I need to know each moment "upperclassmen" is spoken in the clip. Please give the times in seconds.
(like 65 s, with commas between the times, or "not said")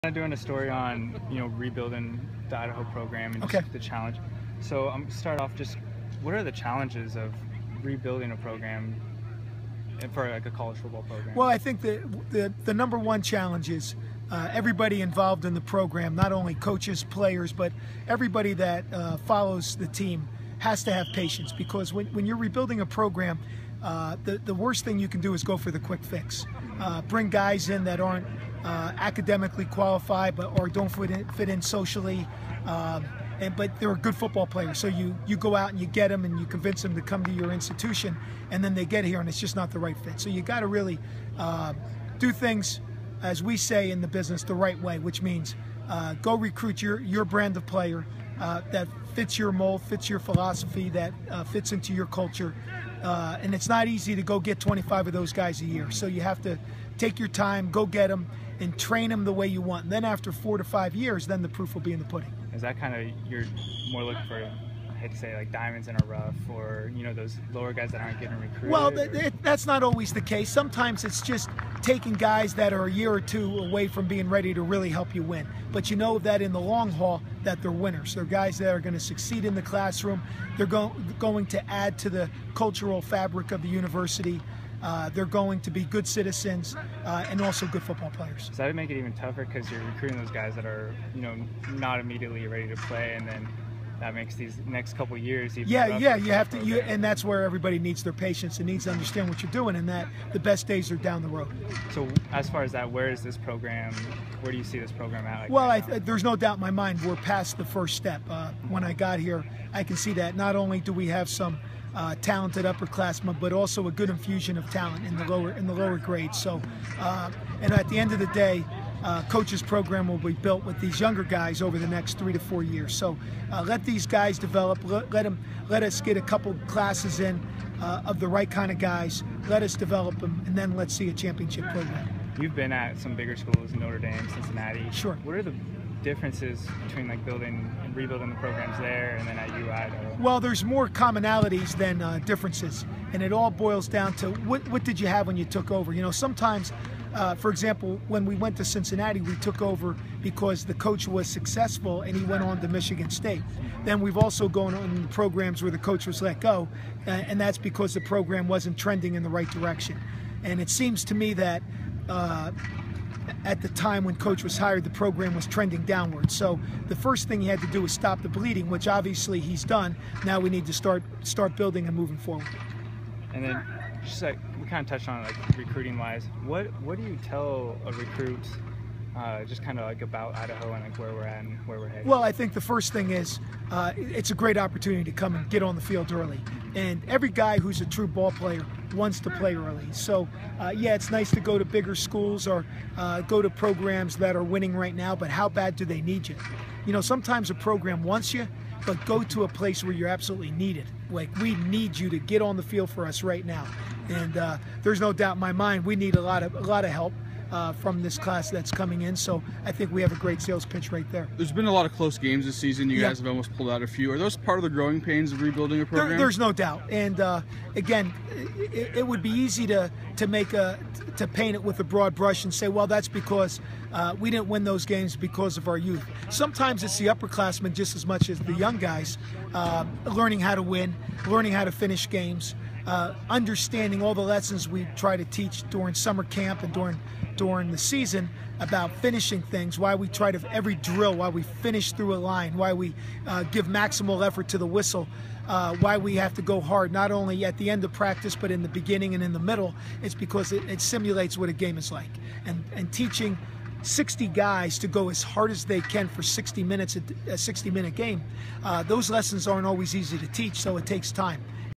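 112 s, 227 s.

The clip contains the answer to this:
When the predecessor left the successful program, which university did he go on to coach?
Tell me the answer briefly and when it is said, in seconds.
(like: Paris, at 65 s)
Michigan State, at 152 s.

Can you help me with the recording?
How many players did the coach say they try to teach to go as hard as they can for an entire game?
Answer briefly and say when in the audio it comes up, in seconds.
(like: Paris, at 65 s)
60, at 253 s.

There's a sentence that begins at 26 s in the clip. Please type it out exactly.
Uh, bring guys in that aren't uh, academically qualified, but or don't fit in, fit in socially.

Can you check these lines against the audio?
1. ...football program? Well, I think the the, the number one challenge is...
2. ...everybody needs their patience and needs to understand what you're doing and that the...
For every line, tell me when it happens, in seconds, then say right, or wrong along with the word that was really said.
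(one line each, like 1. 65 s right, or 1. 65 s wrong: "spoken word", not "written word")
1. 10 s right
2. 97 s right.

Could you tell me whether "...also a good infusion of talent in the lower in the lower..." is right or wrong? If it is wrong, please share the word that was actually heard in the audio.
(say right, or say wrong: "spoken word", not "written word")
right.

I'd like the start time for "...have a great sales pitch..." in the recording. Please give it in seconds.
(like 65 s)
210 s.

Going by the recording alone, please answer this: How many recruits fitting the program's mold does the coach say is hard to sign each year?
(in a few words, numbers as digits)
25.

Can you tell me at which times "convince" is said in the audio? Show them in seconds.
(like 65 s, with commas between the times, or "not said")
36 s.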